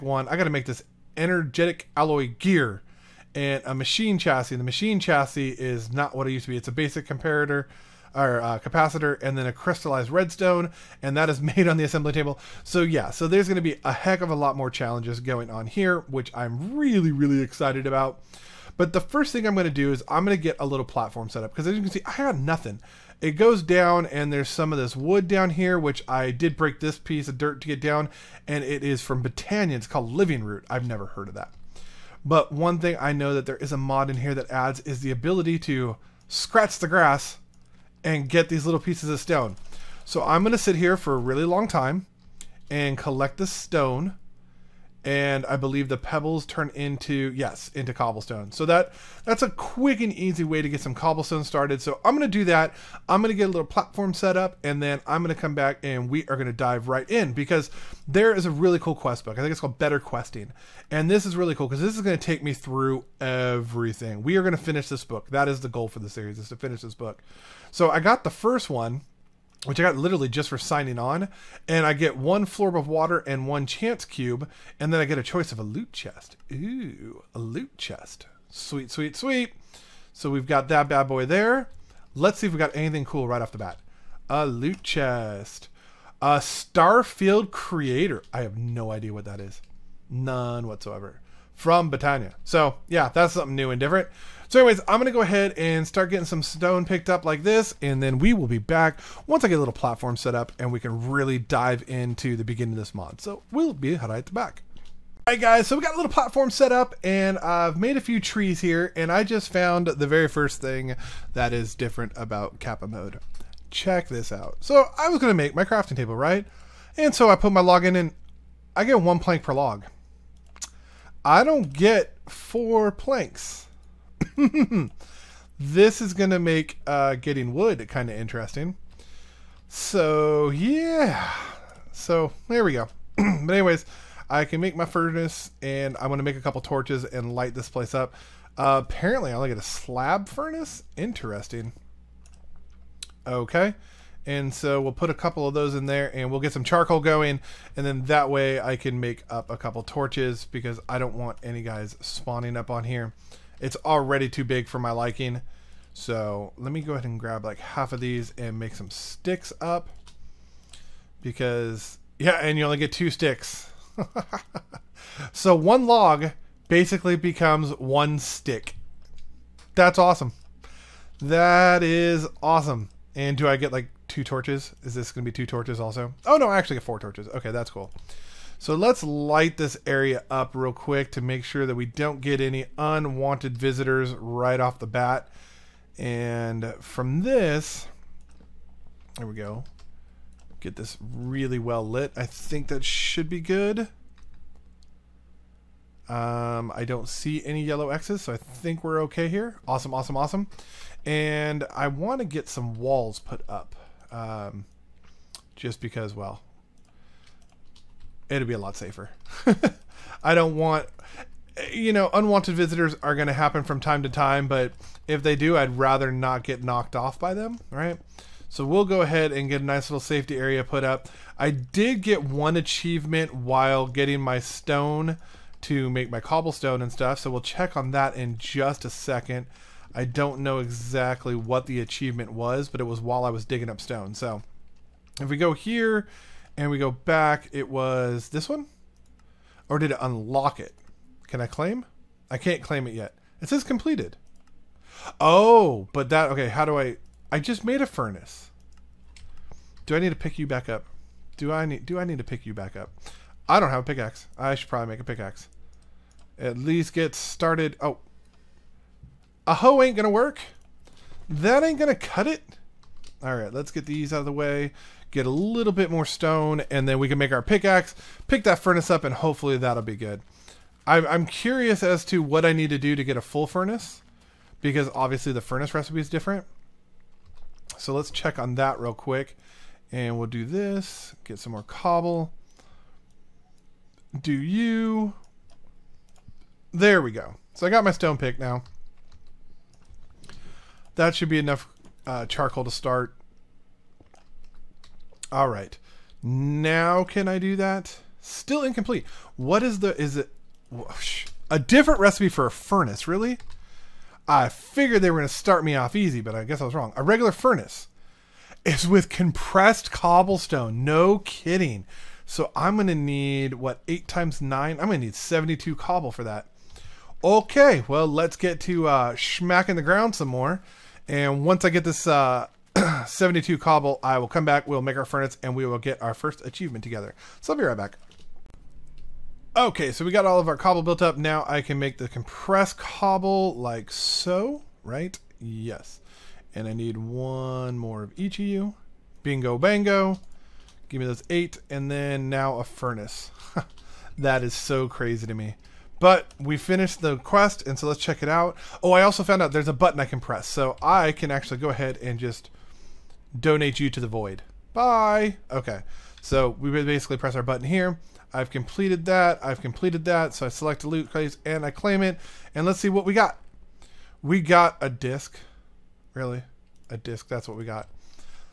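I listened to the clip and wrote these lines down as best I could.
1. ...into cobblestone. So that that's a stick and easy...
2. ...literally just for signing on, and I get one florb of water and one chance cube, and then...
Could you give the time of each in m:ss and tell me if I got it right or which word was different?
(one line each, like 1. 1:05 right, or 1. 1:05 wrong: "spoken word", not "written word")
1. 0:47 wrong: "quick", not "stick"
2. 1:09 right.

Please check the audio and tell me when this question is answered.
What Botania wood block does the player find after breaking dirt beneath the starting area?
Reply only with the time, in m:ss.
0:30.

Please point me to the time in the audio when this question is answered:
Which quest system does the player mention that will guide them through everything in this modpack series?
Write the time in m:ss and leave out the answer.
0:59.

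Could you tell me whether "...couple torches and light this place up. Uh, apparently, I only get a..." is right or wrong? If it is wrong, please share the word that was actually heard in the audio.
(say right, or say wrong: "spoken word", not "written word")
right.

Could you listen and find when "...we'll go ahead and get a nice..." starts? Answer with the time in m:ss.
3:38.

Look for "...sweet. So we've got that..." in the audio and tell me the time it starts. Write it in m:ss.
1:19.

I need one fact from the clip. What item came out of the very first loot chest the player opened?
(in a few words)
Starfield Creator.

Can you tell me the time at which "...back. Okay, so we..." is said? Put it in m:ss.
5:27.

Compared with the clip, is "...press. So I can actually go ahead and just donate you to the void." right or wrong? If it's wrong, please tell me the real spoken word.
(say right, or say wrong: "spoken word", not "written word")
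right.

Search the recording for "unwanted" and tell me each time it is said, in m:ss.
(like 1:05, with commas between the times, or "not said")
3:02, 3:32.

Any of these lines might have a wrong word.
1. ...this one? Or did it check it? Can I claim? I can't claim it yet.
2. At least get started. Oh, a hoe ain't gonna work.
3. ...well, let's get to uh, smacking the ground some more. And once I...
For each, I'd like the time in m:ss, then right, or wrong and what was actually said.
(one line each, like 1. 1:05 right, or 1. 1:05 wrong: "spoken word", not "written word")
1. 3:58 wrong: "unlock", not "check"
2. 4:16 right
3. 5:17 right.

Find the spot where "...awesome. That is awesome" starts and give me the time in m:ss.
2:49.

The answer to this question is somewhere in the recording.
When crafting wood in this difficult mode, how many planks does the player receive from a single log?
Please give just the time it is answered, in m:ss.
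1:59.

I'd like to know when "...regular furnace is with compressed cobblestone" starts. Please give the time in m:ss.
5:07.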